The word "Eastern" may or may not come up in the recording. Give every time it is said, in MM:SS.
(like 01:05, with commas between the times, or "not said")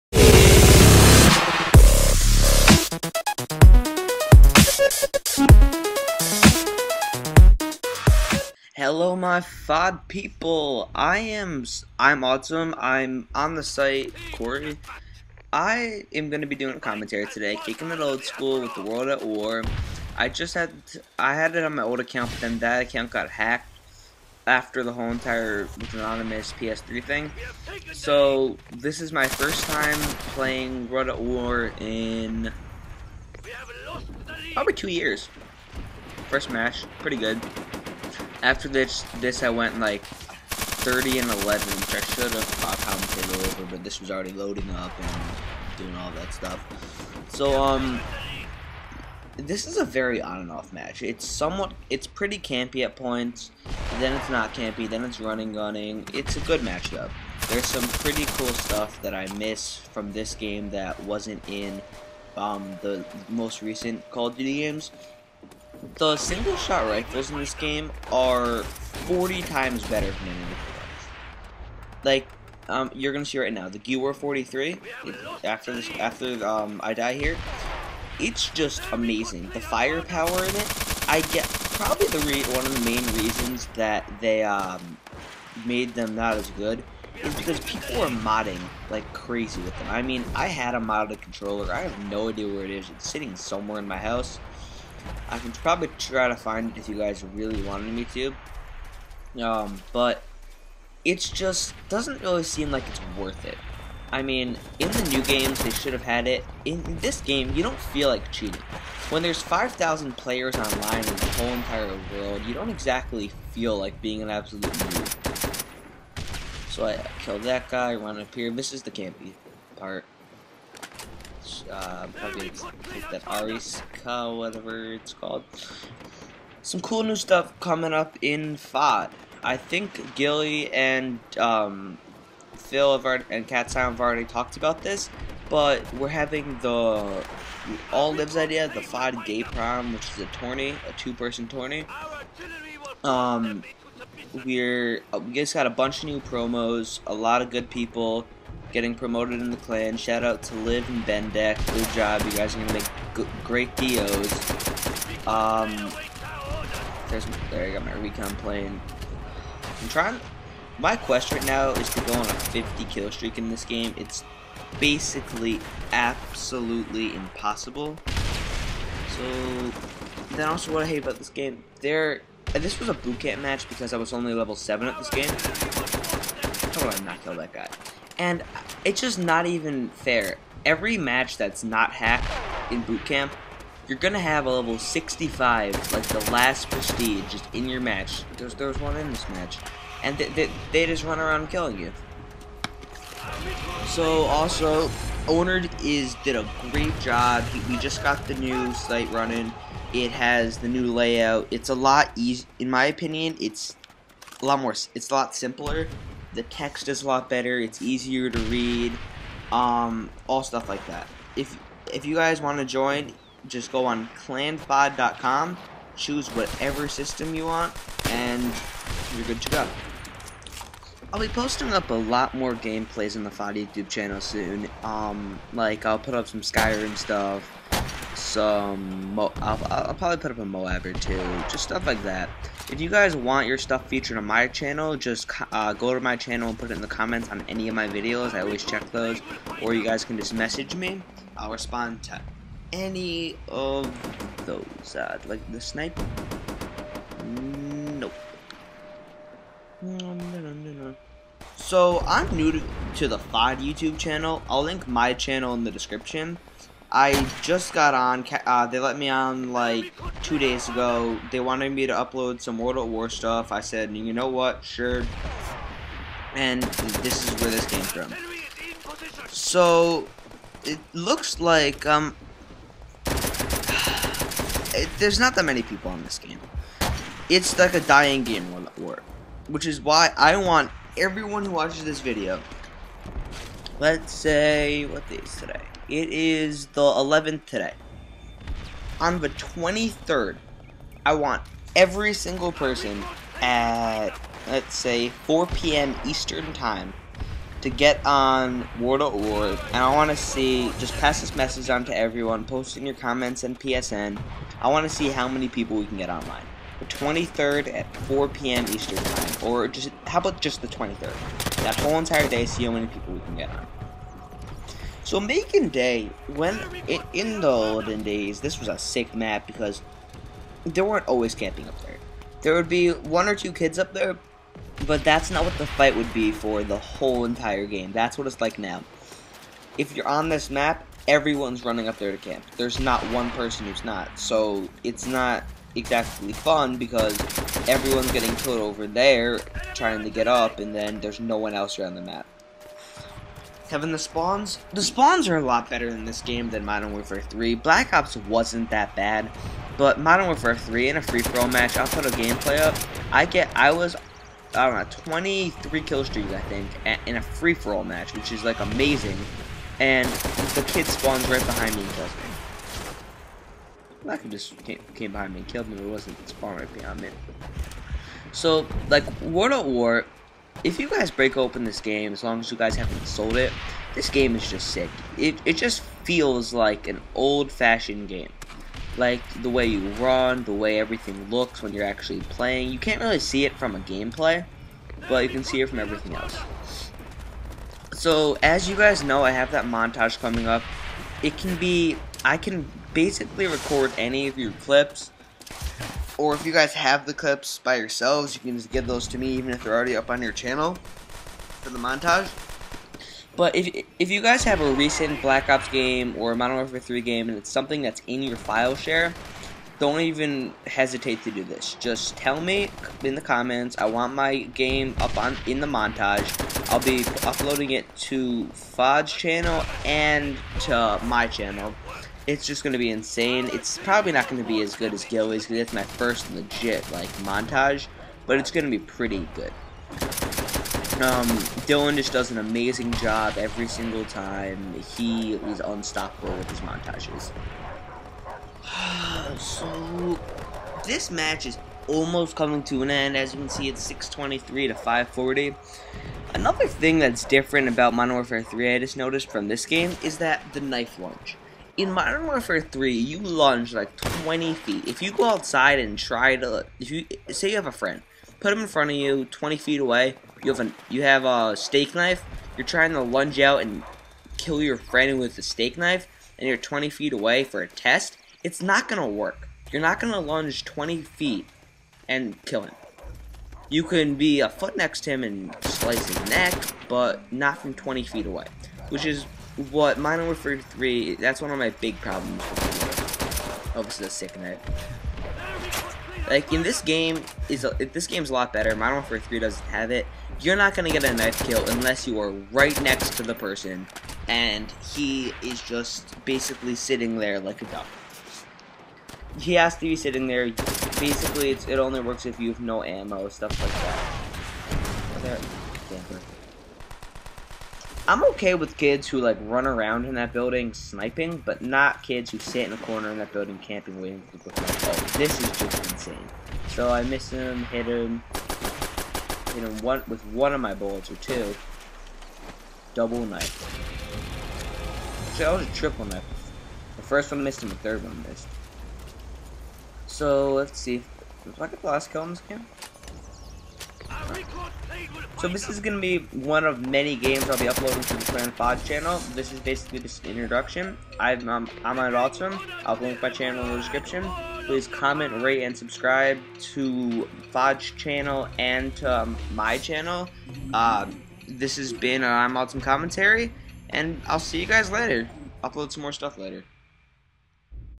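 04:56, 05:08.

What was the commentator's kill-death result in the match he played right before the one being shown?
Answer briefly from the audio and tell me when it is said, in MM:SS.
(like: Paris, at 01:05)
30 and 11, at 00:40.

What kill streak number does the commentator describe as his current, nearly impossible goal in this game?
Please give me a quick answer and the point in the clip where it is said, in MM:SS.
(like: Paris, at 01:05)
50, at 02:42.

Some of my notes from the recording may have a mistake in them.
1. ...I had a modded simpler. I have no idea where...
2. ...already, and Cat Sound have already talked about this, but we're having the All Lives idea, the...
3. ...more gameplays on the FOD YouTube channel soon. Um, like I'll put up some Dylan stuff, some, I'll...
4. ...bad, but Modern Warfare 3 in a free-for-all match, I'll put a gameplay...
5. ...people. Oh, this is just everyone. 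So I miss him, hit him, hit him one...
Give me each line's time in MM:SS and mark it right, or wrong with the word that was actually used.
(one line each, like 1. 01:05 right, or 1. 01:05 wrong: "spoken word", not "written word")
1. 01:30 wrong: "controller", not "simpler"
2. 02:13 right
3. 03:42 wrong: "Skyrim", not "Dylan"
4. 05:48 right
5. 08:34 wrong: "insane", not "everyone".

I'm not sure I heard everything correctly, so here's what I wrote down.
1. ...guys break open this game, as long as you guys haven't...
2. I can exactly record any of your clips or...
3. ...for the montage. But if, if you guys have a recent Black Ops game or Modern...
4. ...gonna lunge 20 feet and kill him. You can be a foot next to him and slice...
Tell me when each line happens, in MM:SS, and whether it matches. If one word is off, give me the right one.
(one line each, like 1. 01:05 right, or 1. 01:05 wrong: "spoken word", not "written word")
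1. 06:10 right
2. 06:32 wrong: "basically", not "exactly"
3. 06:41 right
4. 07:49 right.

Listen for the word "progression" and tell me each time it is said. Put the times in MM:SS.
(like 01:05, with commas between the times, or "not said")
not said.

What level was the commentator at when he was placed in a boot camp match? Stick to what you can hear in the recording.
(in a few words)
level 7.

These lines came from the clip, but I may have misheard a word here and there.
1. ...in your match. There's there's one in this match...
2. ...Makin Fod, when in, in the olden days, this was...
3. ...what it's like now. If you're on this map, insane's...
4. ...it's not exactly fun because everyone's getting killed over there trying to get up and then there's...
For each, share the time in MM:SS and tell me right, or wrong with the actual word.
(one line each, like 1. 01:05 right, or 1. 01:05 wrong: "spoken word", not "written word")
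1. 03:07 right
2. 05:15 wrong: "Day", not "Fod"
3. 05:28 wrong: "everyone", not "insane"
4. 05:34 right.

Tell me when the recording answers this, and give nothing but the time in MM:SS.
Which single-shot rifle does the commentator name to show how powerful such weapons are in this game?
01:13.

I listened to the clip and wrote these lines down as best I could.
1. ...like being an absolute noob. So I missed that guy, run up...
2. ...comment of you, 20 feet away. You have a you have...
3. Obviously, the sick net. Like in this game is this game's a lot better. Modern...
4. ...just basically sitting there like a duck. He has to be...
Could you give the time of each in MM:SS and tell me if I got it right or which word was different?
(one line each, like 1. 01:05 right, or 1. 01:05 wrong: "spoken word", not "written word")
1. 01:53 wrong: "killed", not "missed"
2. 07:38 wrong: "front", not "comment"
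3. 08:03 right
4. 08:15 right.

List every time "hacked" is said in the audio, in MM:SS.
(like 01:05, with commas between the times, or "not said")
00:23, 03:01.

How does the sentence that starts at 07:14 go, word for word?
He is unstoppable with his montages.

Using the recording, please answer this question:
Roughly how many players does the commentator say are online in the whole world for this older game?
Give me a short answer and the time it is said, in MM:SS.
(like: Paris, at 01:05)
5,000, at 01:49.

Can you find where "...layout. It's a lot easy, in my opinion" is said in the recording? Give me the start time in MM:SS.
03:20.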